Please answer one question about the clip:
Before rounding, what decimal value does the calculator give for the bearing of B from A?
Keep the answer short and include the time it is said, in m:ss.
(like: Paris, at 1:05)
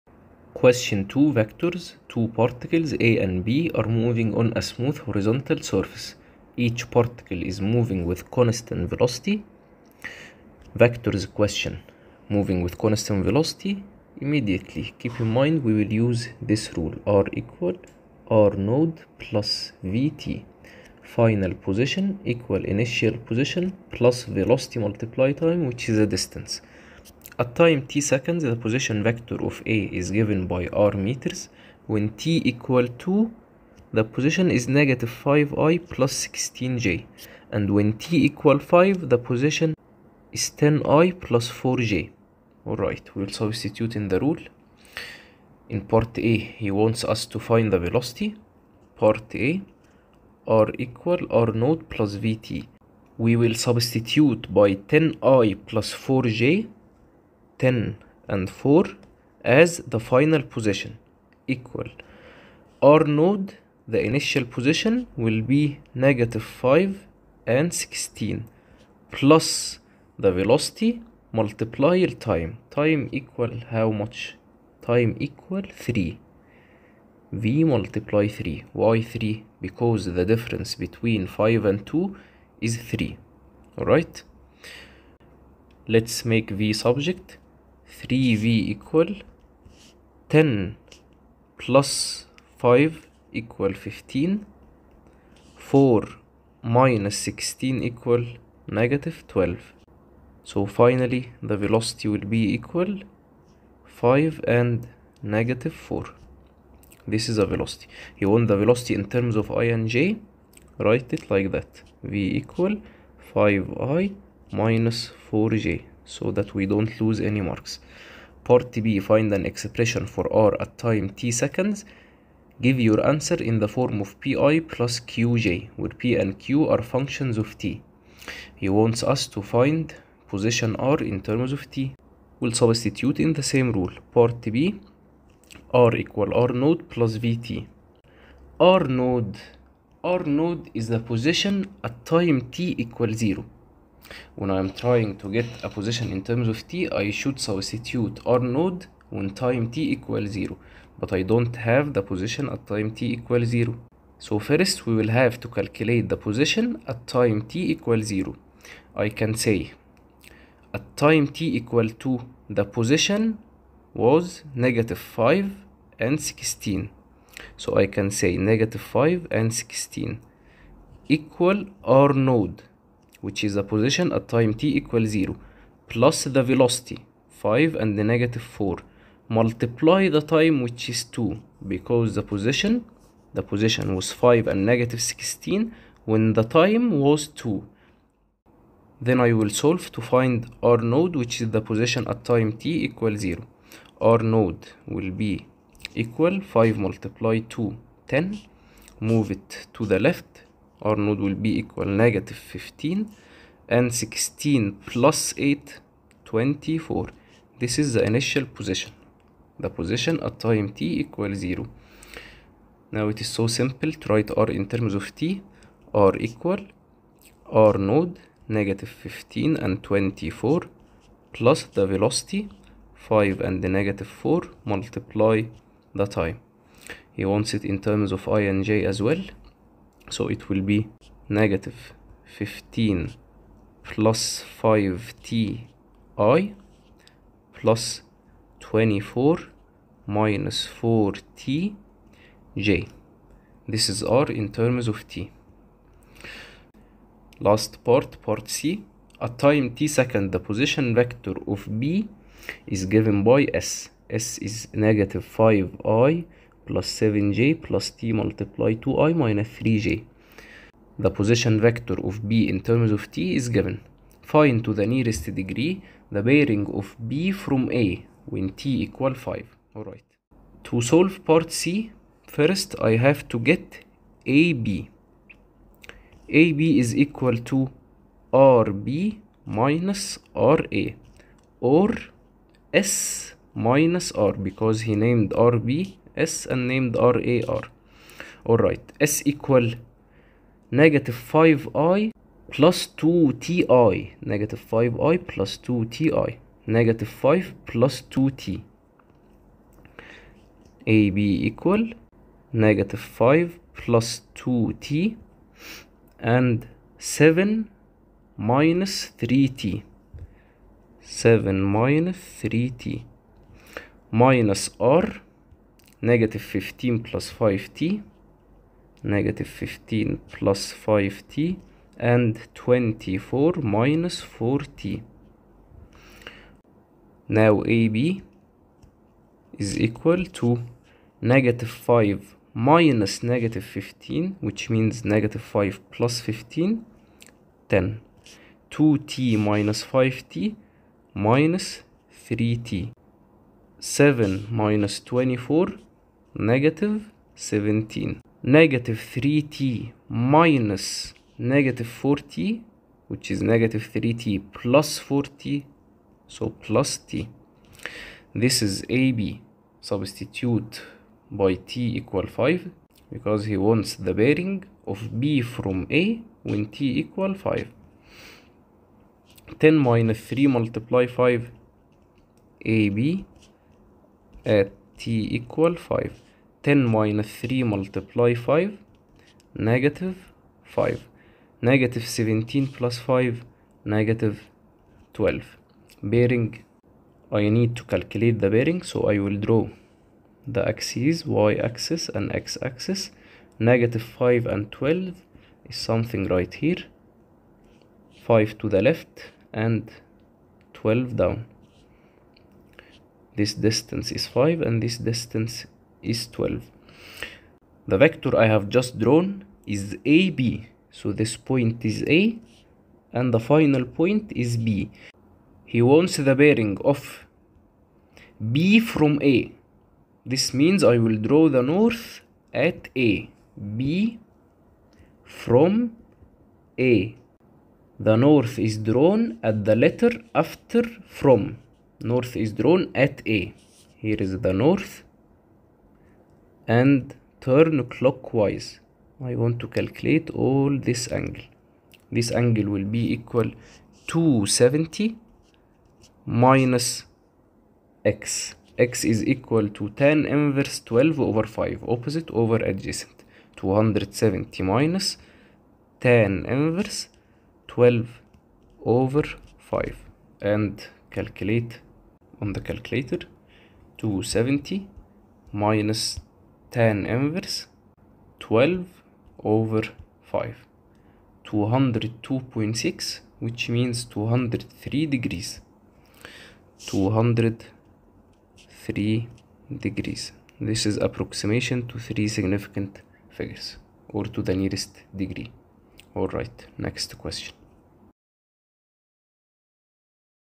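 202.6, at 7:51.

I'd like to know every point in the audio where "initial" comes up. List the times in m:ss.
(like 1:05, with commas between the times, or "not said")
0:22, 1:04, 3:28.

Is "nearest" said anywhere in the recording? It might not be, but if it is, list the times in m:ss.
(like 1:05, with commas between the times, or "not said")
4:24, 8:04.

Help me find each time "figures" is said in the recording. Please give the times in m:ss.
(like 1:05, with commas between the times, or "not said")
8:03.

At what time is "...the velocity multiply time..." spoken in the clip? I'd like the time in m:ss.
1:10.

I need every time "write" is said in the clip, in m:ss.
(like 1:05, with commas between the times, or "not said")
1:50, 3:34.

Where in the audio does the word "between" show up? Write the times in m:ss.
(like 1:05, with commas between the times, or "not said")
1:20.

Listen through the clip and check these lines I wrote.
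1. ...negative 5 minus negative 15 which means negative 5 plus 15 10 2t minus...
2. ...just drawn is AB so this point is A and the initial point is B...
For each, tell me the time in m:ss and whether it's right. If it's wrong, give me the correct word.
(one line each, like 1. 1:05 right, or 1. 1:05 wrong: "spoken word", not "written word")
1. 5:31 right
2. 6:48 wrong: "final", not "initial".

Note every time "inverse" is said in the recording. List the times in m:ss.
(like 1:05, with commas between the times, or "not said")
7:30, 7:36, 7:47.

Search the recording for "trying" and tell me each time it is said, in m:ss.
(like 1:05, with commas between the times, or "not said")
2:24.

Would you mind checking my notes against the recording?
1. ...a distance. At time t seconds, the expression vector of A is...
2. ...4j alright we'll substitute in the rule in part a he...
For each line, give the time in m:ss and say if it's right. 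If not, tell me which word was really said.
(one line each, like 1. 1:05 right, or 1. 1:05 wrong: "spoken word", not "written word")
1. 0:25 wrong: "position", not "expression"
2. 0:41 right.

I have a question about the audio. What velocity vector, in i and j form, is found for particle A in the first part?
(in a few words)
5i - 4j.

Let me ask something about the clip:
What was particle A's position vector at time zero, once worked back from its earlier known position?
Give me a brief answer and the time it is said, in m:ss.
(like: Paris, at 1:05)
-15i + 24j, at 3:21.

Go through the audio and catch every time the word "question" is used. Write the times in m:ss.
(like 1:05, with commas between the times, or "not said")
0:00, 0:11, 8:07.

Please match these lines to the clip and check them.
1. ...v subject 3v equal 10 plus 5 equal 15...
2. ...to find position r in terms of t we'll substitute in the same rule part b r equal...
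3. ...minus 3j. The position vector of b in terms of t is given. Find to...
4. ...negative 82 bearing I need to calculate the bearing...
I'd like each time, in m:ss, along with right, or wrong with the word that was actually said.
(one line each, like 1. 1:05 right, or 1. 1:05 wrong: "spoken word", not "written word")
1. 1:26 right
2. 2:09 right
3. 4:19 right
4. 6:23 wrong: "12", not "82".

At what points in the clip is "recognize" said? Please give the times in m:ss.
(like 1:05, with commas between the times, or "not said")
not said.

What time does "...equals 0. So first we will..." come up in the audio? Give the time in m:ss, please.
2:33.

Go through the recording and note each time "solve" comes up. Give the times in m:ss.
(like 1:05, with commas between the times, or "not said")
3:09, 4:30.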